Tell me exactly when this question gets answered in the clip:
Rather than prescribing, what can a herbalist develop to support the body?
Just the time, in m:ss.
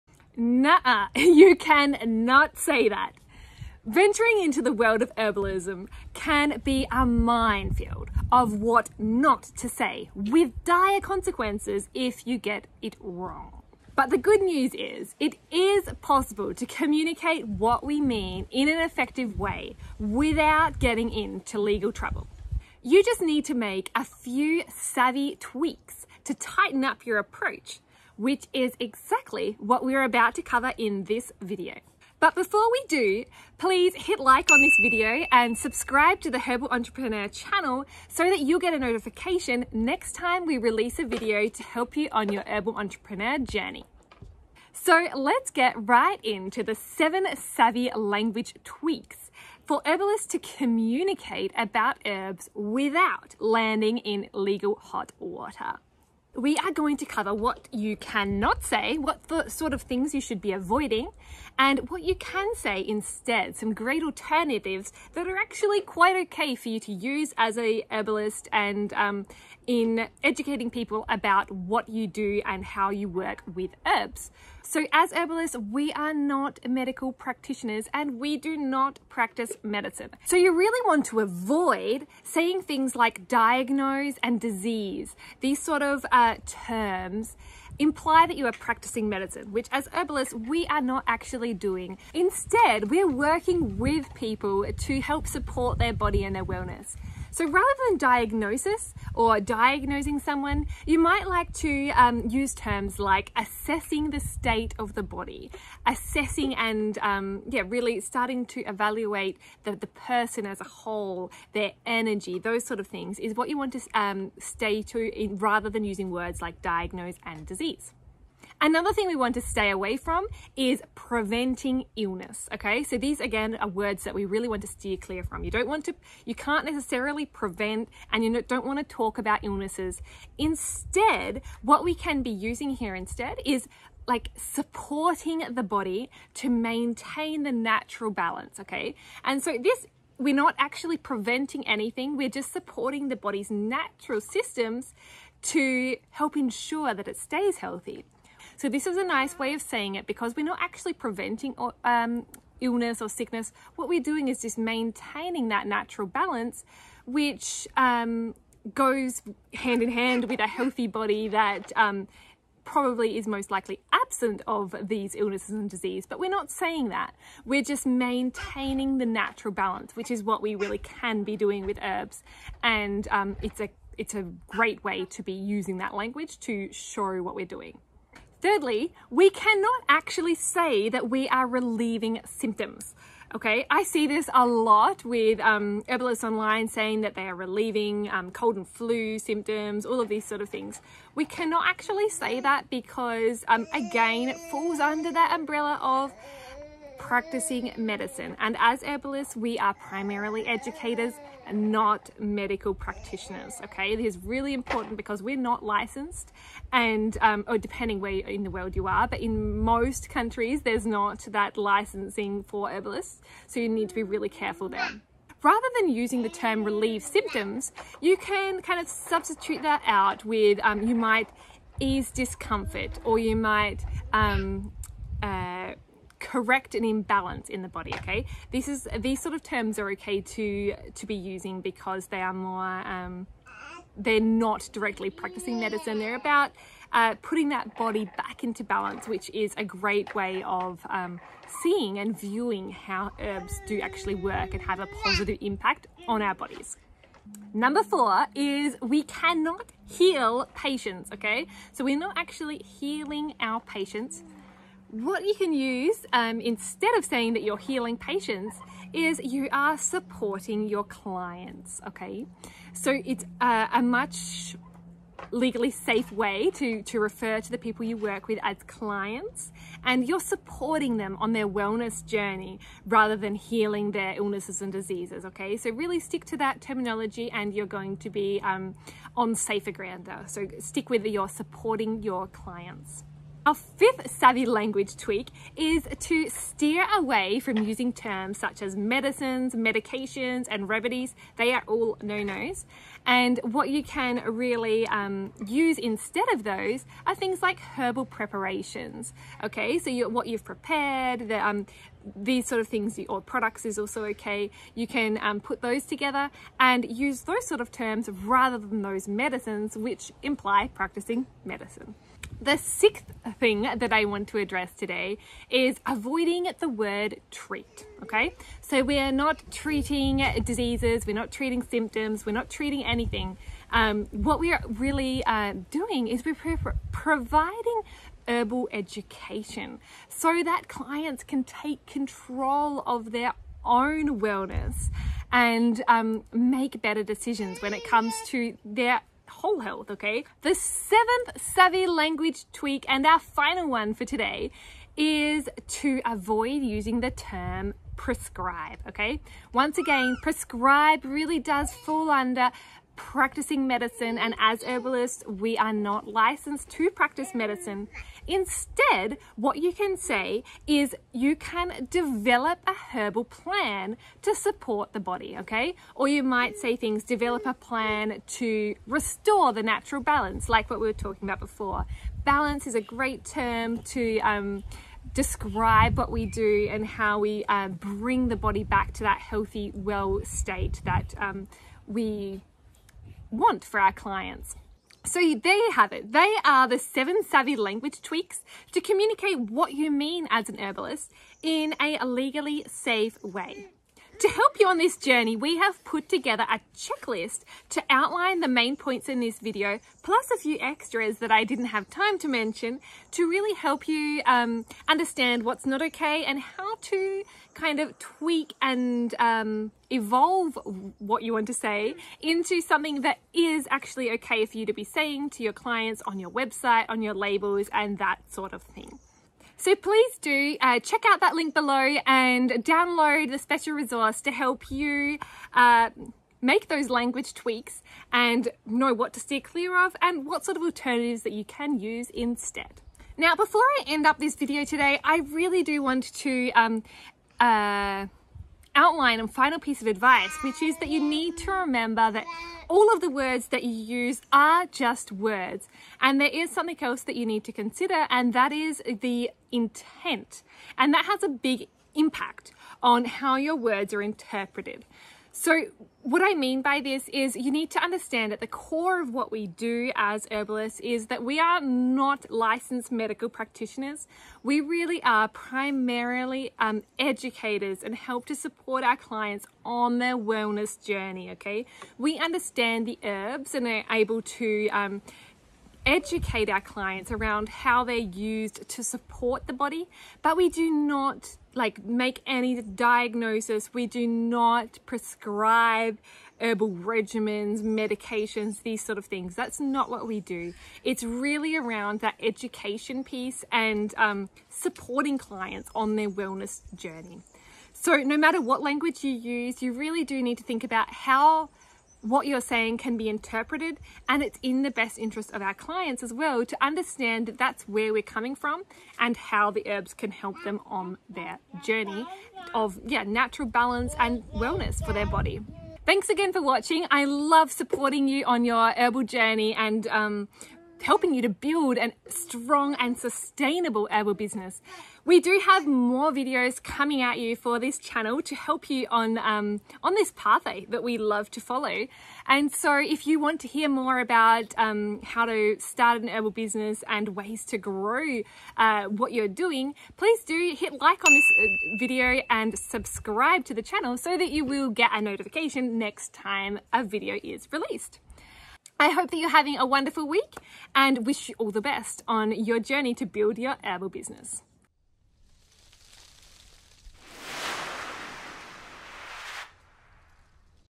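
6:02.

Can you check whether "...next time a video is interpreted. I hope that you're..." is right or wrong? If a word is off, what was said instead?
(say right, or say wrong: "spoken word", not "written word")
wrong: "released", not "interpreted".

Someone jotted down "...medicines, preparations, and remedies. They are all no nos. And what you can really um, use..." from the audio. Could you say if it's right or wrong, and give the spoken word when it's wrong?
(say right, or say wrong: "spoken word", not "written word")
wrong: "medications", not "preparations".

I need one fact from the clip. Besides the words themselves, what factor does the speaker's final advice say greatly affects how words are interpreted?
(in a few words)
intent.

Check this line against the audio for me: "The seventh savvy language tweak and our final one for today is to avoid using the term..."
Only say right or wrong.
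right.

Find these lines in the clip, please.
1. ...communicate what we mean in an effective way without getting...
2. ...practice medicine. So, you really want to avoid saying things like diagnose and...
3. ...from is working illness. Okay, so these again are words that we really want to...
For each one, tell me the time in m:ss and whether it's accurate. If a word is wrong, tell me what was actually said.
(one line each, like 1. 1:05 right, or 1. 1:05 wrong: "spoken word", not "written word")
1. 0:16 right
2. 1:19 right
3. 1:59 wrong: "preventing", not "working".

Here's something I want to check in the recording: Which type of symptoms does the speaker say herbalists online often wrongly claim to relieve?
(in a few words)
cold and flu.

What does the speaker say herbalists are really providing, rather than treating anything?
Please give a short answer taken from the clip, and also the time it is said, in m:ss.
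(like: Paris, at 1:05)
herbal education, at 5:28.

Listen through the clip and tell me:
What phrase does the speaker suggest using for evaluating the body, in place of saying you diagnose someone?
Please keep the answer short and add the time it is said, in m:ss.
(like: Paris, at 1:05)
assessing the state of the body, at 1:43.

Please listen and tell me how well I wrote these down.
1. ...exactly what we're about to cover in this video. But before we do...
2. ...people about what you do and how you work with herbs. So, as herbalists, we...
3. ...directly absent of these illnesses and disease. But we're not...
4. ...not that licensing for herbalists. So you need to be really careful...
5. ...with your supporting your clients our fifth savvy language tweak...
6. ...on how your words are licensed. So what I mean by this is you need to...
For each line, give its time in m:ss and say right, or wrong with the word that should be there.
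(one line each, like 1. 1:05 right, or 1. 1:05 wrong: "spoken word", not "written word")
1. 0:28 right
2. 1:10 right
3. 2:43 wrong: "likely", not "directly"
4. 3:30 right
5. 4:40 right
6. 7:32 wrong: "interpreted", not "licensed".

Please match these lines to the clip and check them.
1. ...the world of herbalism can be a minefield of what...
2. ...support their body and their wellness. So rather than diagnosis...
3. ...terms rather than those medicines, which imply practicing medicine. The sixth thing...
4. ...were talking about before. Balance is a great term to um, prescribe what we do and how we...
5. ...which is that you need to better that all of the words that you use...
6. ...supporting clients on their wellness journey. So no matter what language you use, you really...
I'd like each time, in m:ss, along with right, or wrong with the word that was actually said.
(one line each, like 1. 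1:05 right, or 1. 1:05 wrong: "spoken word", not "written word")
1. 0:04 right
2. 1:35 right
3. 5:07 right
4. 6:10 wrong: "describe", not "prescribe"
5. 7:20 wrong: "remember", not "better"
6. 8:14 right.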